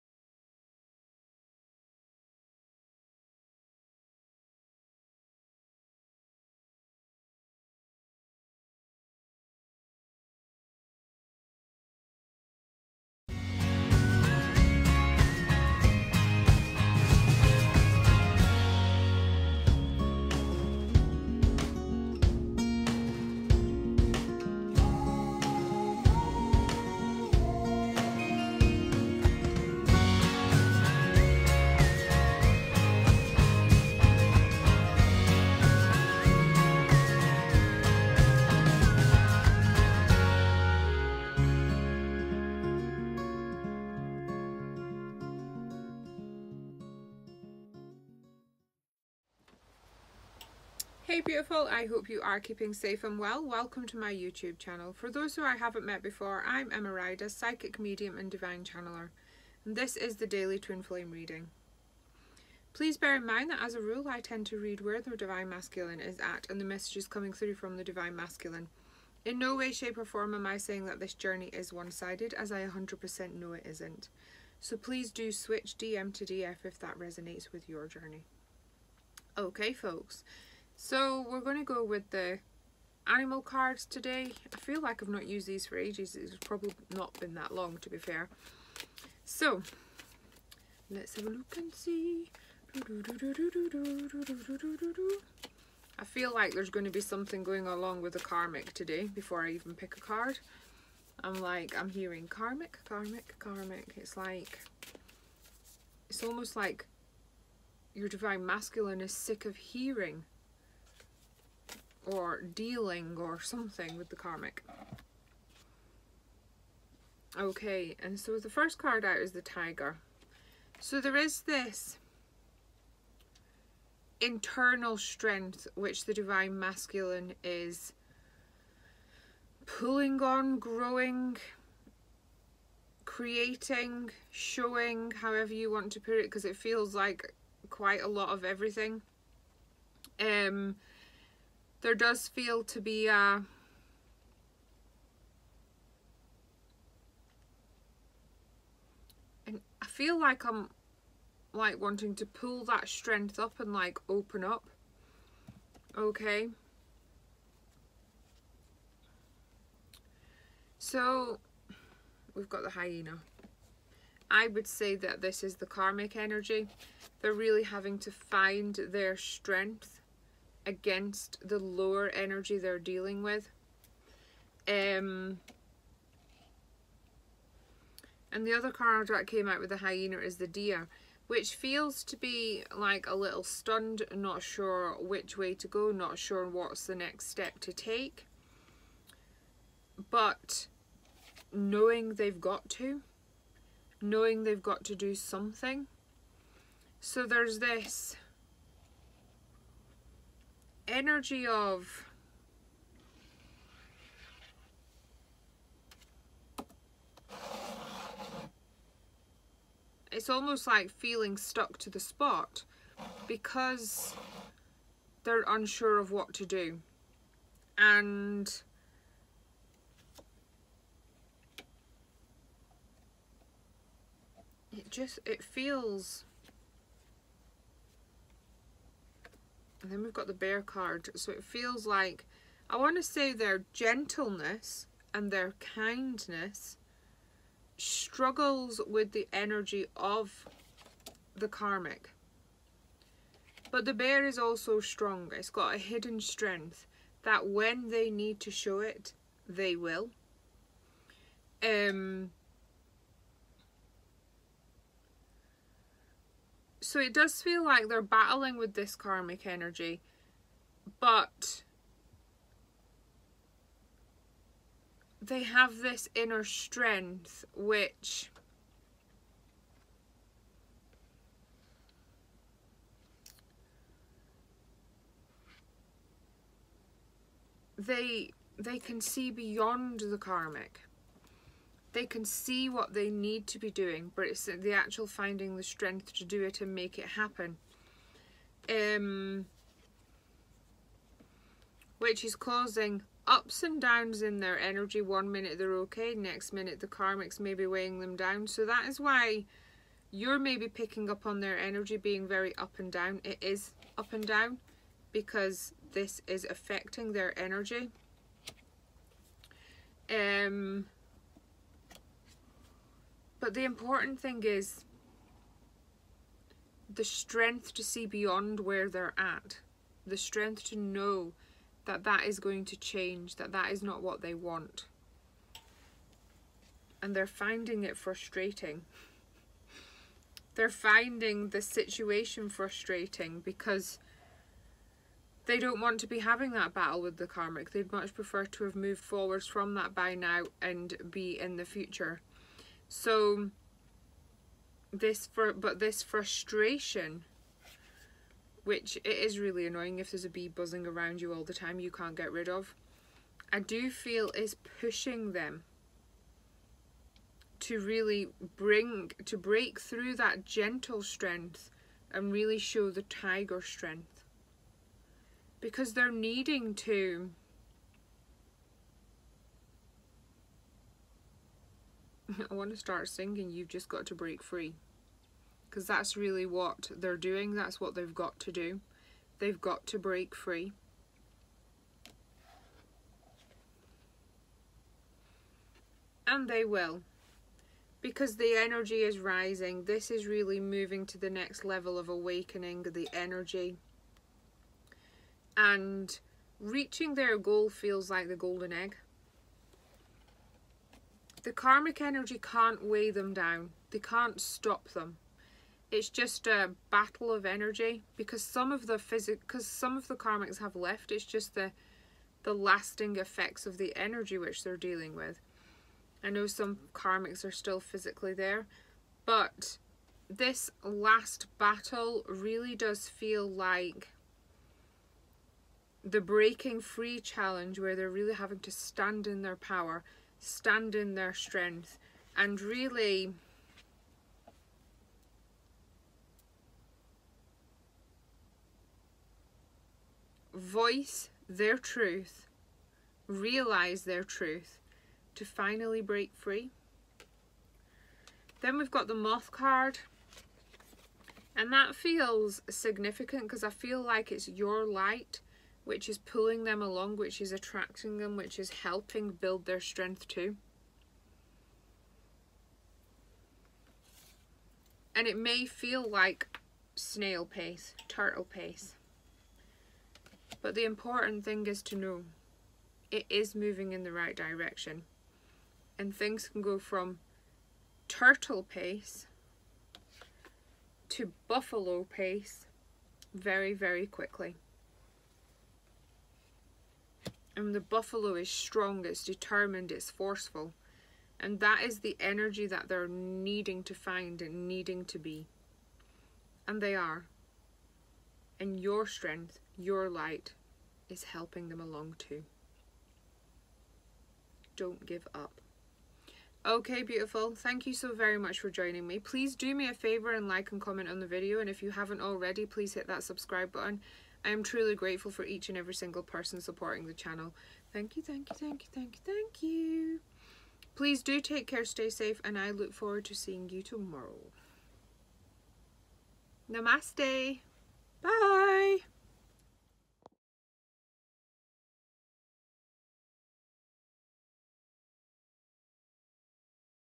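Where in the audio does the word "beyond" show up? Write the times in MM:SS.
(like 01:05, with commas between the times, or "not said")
04:39, 05:18.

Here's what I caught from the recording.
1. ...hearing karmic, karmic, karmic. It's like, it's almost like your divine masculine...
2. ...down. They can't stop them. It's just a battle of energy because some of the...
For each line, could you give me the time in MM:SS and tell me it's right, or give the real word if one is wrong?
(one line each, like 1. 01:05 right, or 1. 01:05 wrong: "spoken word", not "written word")
1. 01:41 right
2. 06:43 right.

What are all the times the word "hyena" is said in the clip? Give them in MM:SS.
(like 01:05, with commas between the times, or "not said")
02:42, 02:59.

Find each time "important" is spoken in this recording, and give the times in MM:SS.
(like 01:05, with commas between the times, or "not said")
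05:13, 07:50.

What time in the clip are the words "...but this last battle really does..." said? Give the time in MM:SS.
06:59.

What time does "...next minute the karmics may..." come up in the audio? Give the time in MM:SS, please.
04:56.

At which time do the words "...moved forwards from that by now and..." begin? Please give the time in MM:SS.
05:38.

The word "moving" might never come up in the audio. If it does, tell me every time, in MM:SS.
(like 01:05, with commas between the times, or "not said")
06:30, 07:53.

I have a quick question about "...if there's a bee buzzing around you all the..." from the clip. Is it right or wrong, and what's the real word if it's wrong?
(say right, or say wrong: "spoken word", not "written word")
right.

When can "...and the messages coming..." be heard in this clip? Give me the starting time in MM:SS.
01:06.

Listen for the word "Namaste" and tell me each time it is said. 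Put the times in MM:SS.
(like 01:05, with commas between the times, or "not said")
08:46.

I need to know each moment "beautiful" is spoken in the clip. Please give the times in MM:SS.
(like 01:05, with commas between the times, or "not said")
00:51, 08:27.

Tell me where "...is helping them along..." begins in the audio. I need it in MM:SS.
08:21.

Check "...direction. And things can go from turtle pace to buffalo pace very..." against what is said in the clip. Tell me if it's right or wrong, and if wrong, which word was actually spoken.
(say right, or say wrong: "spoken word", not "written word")
right.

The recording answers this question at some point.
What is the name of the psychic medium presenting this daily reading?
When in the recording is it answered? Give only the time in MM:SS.
00:56.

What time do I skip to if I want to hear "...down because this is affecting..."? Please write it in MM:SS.
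05:04.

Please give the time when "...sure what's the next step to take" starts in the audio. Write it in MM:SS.
03:06.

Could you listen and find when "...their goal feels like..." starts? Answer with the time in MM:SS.
06:37.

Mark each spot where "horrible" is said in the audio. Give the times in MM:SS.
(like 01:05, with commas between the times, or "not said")
not said.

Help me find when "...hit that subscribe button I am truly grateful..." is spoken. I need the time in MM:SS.
08:32.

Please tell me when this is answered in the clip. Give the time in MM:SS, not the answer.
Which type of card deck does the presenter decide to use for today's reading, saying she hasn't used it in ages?
01:23.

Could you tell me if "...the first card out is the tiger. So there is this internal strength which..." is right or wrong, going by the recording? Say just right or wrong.
right.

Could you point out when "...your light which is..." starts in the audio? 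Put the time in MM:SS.
07:34.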